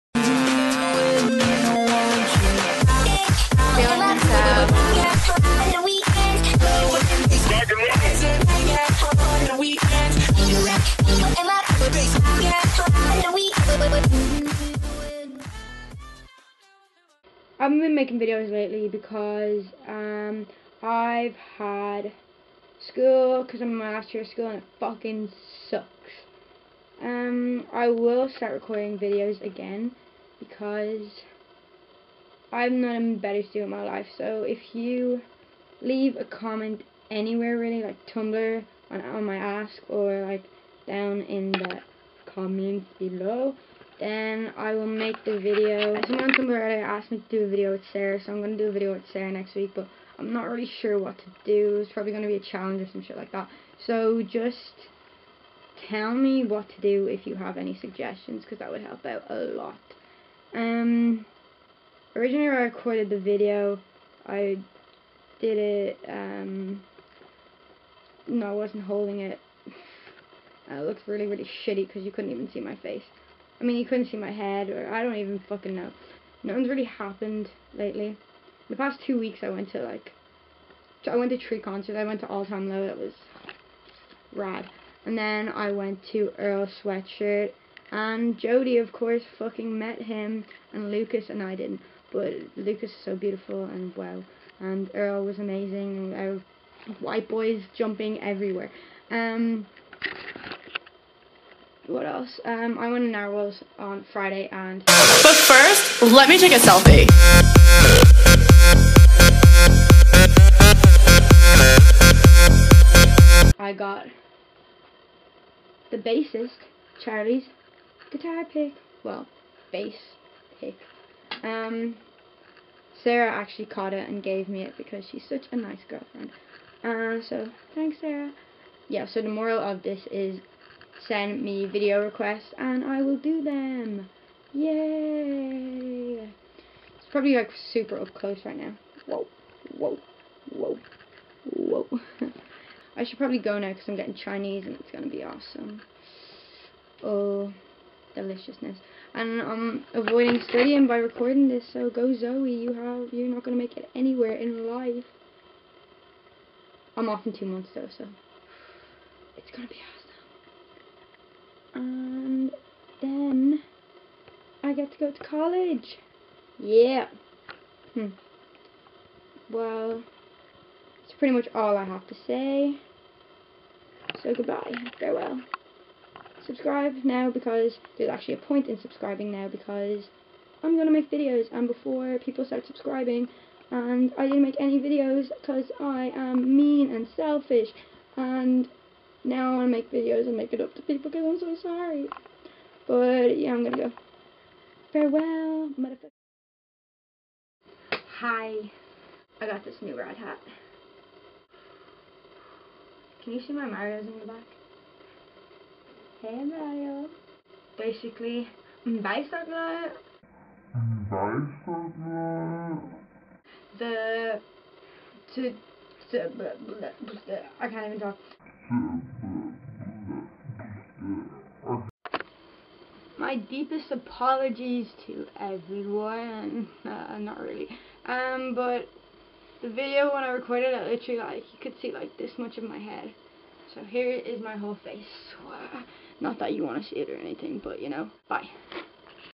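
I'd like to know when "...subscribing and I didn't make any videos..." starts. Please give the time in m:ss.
3:02.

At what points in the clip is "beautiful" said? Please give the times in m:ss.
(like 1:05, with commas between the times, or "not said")
1:33.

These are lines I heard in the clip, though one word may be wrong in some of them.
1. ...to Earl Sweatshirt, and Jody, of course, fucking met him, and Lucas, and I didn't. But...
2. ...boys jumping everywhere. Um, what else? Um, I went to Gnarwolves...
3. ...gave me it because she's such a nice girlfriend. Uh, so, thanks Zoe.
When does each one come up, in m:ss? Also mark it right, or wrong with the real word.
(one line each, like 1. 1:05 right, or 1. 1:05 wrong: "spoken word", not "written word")
1. 1:26 right
2. 1:37 right
3. 2:04 wrong: "Sarah", not "Zoe".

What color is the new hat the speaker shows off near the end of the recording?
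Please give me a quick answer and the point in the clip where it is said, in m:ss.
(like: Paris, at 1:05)
Red, at 3:19.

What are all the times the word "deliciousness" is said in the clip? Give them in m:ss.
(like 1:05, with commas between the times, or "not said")
2:28.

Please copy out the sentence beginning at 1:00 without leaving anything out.
Um, originally I recorded the video.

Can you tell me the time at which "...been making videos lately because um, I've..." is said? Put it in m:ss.
0:17.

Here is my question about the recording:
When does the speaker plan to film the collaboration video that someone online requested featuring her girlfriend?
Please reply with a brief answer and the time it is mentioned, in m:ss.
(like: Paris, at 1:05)
Next week, at 0:49.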